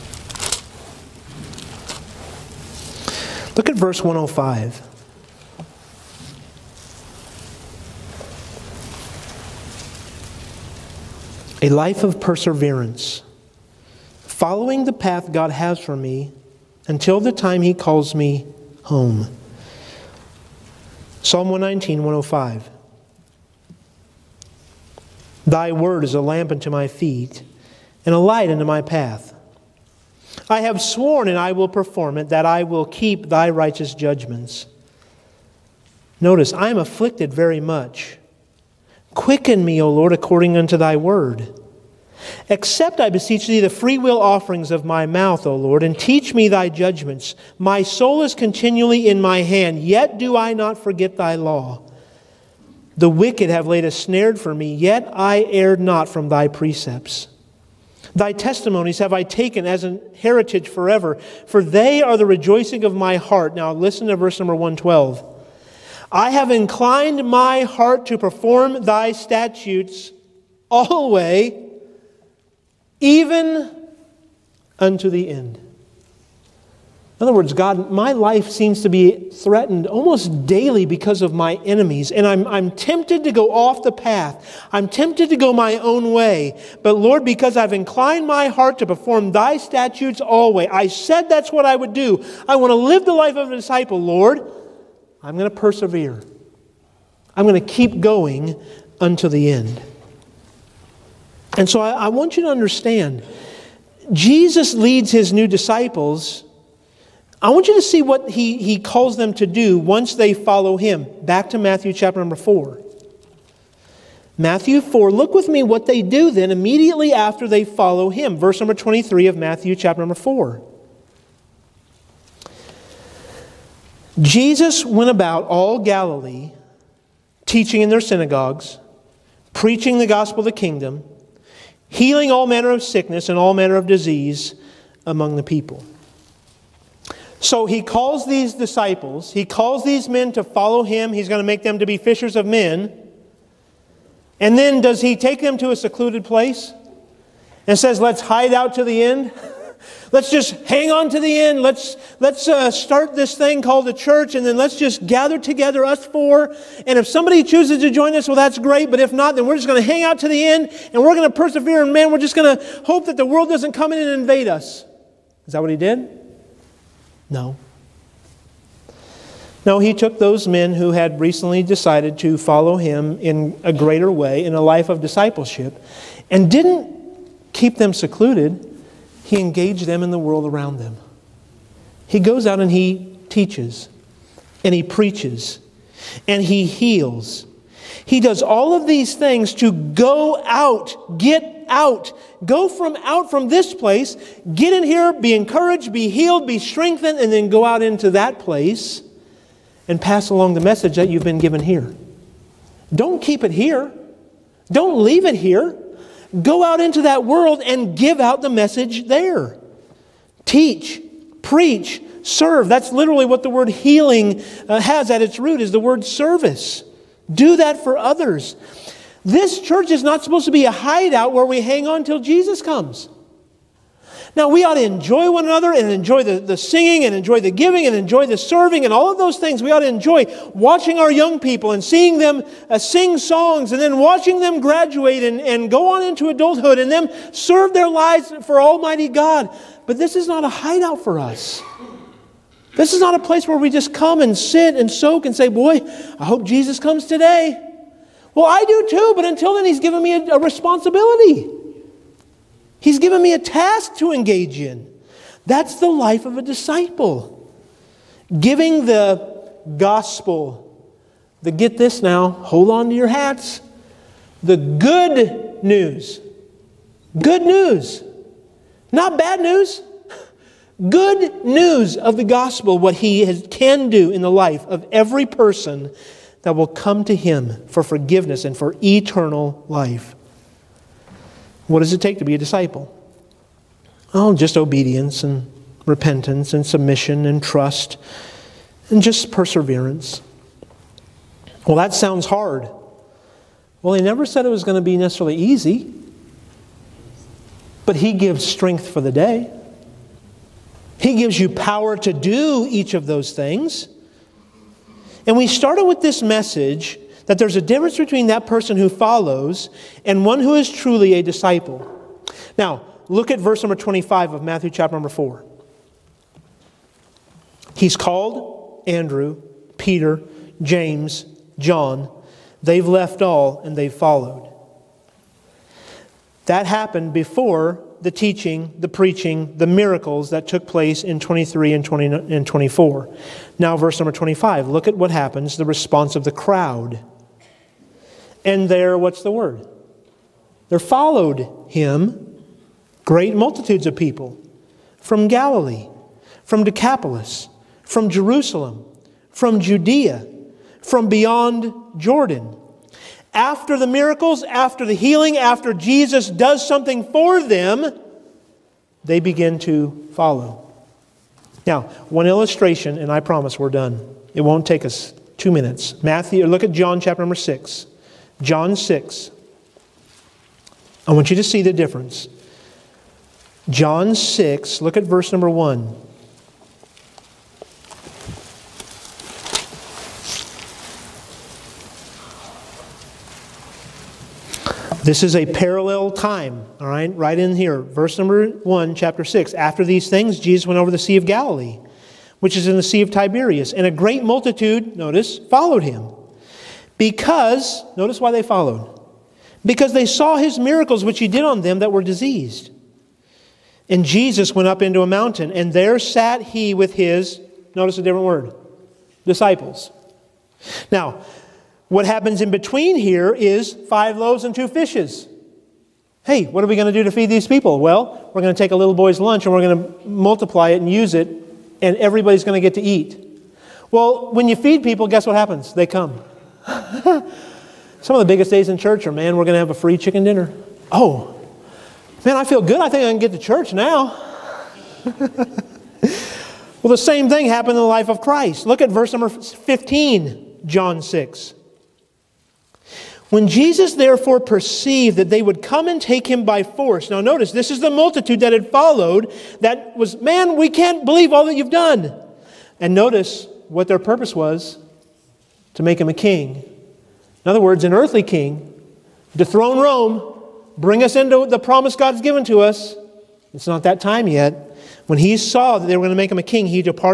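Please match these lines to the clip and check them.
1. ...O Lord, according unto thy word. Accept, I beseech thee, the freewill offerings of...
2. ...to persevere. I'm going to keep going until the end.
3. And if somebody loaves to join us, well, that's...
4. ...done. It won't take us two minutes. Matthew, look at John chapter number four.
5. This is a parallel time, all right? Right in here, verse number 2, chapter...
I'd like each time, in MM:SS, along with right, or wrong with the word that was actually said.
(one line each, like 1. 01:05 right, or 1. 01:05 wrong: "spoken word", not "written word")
1. 00:39 right
2. 01:35 right
3. 02:36 wrong: "chooses", not "loaves"
4. 06:03 wrong: "six", not "four"
5. 06:25 wrong: "1", not "2".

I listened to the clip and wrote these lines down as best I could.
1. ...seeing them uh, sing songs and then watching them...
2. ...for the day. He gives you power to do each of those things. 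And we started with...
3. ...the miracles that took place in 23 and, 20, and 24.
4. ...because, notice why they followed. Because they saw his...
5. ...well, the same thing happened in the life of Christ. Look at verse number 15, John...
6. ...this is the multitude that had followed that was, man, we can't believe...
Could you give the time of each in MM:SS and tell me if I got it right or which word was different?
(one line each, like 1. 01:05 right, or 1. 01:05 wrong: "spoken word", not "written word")
1. 03:51 right
2. 04:58 right
3. 05:29 right
4. 06:36 right
5. 07:15 right
6. 07:27 right.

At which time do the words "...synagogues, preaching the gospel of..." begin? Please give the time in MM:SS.
02:08.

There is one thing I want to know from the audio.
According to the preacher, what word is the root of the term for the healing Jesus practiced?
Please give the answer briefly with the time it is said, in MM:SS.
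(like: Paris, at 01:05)
service, at 03:36.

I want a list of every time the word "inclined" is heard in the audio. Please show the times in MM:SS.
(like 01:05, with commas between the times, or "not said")
01:06, 01:27.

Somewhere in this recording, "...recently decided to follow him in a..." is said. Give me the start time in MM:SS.
02:51.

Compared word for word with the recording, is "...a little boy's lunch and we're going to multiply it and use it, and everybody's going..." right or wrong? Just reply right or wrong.
right.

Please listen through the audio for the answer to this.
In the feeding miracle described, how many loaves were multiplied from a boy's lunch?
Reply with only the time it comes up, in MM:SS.
06:53.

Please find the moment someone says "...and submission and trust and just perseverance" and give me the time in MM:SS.
04:46.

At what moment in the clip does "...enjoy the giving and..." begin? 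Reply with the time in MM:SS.
03:47.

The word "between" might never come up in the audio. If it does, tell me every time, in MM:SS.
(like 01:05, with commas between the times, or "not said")
05:07, 06:52.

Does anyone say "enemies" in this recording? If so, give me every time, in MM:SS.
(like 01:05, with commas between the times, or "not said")
01:21.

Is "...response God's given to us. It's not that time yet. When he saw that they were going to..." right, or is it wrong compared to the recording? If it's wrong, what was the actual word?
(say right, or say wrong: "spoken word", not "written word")
wrong: "promise", not "response".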